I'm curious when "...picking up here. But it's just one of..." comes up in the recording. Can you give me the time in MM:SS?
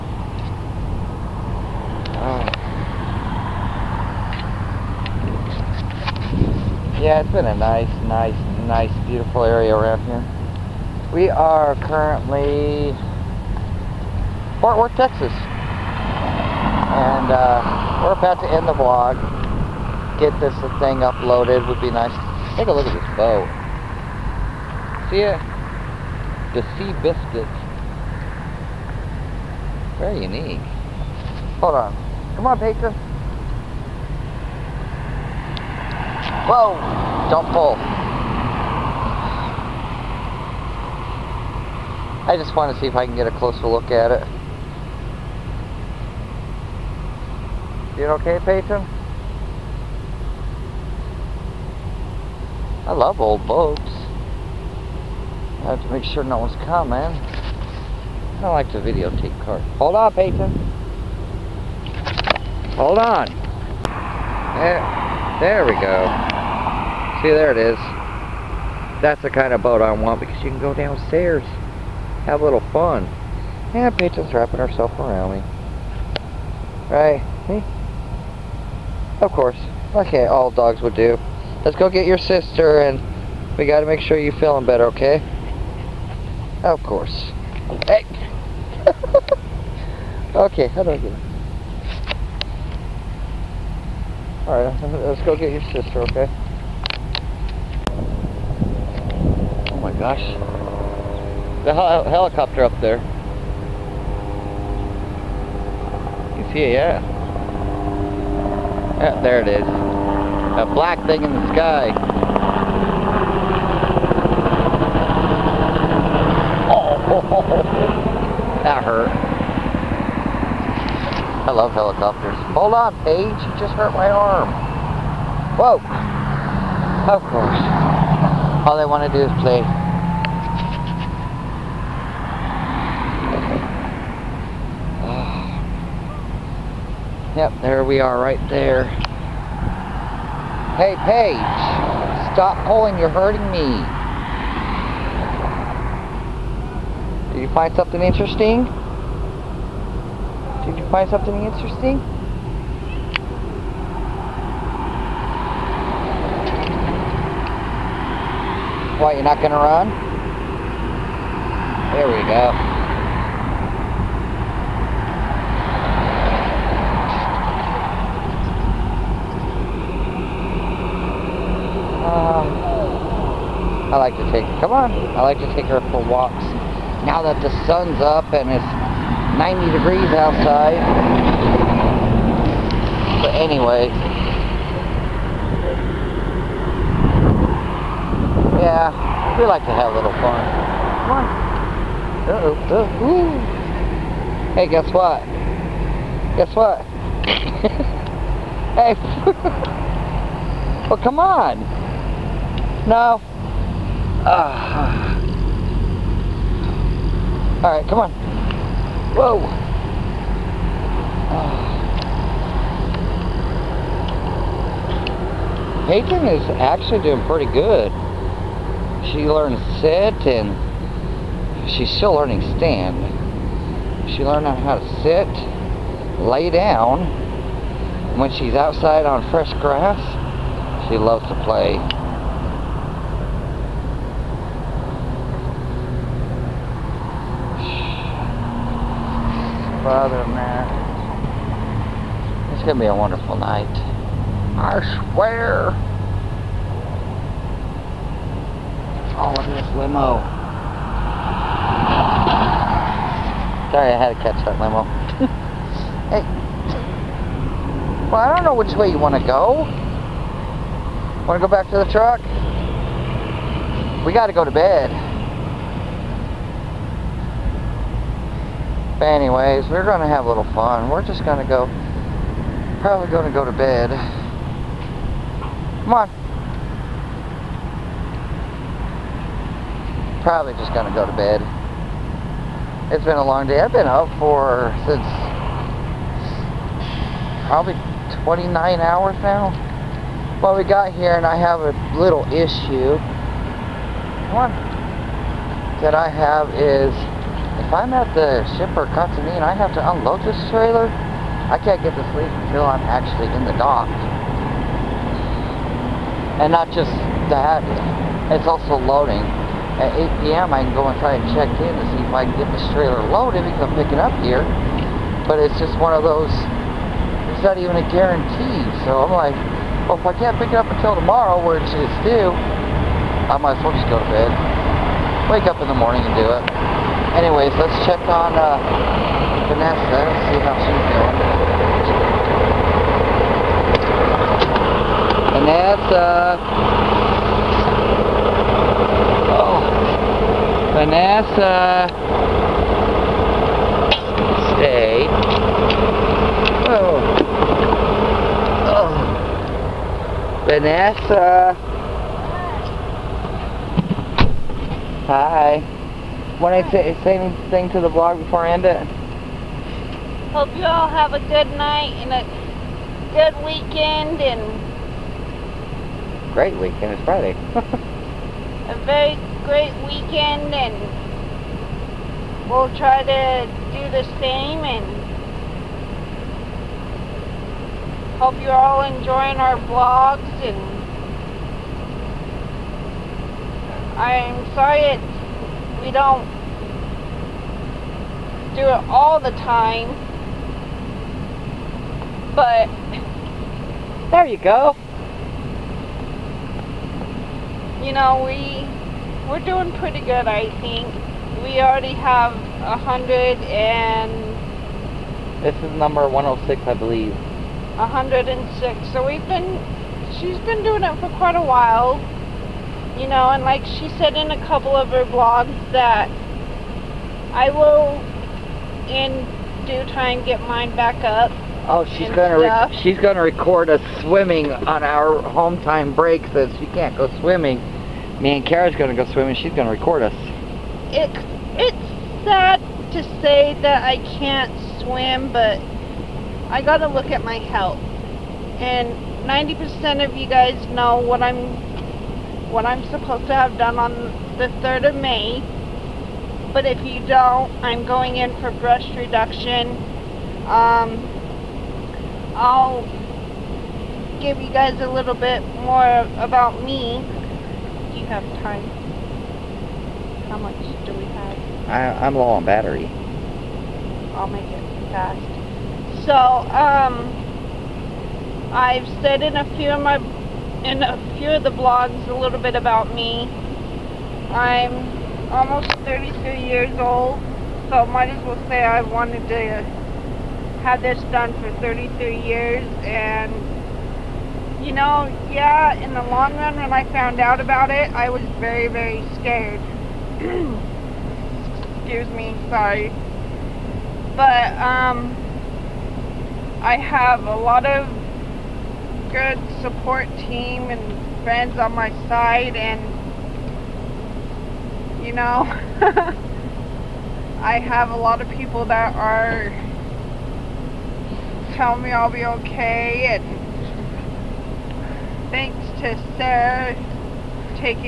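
05:13.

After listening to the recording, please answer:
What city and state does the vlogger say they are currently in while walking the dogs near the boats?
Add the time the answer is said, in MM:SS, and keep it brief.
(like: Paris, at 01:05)
Fort Worth, Texas, at 00:14.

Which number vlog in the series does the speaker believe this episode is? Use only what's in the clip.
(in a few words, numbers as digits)
106.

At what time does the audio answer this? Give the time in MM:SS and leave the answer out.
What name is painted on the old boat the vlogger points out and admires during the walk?
00:26.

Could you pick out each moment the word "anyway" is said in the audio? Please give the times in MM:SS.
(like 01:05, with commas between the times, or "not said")
03:03, 04:29, 05:27.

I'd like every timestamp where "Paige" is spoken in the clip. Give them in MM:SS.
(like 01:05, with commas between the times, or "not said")
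02:03, 02:21.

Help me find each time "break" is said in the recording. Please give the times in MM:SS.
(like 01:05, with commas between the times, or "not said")
07:05.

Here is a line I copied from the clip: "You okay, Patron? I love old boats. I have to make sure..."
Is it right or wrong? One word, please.
right.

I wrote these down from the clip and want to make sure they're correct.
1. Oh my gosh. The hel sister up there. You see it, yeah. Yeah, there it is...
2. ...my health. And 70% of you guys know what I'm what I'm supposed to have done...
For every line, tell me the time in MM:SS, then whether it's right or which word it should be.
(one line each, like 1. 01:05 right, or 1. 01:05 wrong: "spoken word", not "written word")
1. 01:39 wrong: "helicopter", not "sister"
2. 07:17 wrong: "90", not "70".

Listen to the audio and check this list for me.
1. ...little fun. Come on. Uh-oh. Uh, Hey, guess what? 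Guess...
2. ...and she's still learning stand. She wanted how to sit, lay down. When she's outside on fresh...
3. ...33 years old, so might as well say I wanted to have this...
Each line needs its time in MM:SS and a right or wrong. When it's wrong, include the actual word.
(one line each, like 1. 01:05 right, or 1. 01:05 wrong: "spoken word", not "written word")
1. 03:09 right
2. 03:40 wrong: "learned", not "wanted"
3. 07:55 right.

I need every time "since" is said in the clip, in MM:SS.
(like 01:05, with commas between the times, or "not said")
04:44, 07:06.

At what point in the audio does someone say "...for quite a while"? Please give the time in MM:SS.
06:50.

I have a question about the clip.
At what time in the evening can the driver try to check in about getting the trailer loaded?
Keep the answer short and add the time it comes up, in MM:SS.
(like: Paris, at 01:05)
8 p.m., at 05:09.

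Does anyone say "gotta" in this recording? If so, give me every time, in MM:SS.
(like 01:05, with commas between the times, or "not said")
01:23, 07:16.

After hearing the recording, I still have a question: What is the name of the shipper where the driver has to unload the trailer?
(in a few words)
Katsumi.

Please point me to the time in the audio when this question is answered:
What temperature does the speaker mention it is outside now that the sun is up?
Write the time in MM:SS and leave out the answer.
02:59.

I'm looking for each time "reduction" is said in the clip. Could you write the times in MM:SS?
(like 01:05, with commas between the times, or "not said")
07:28.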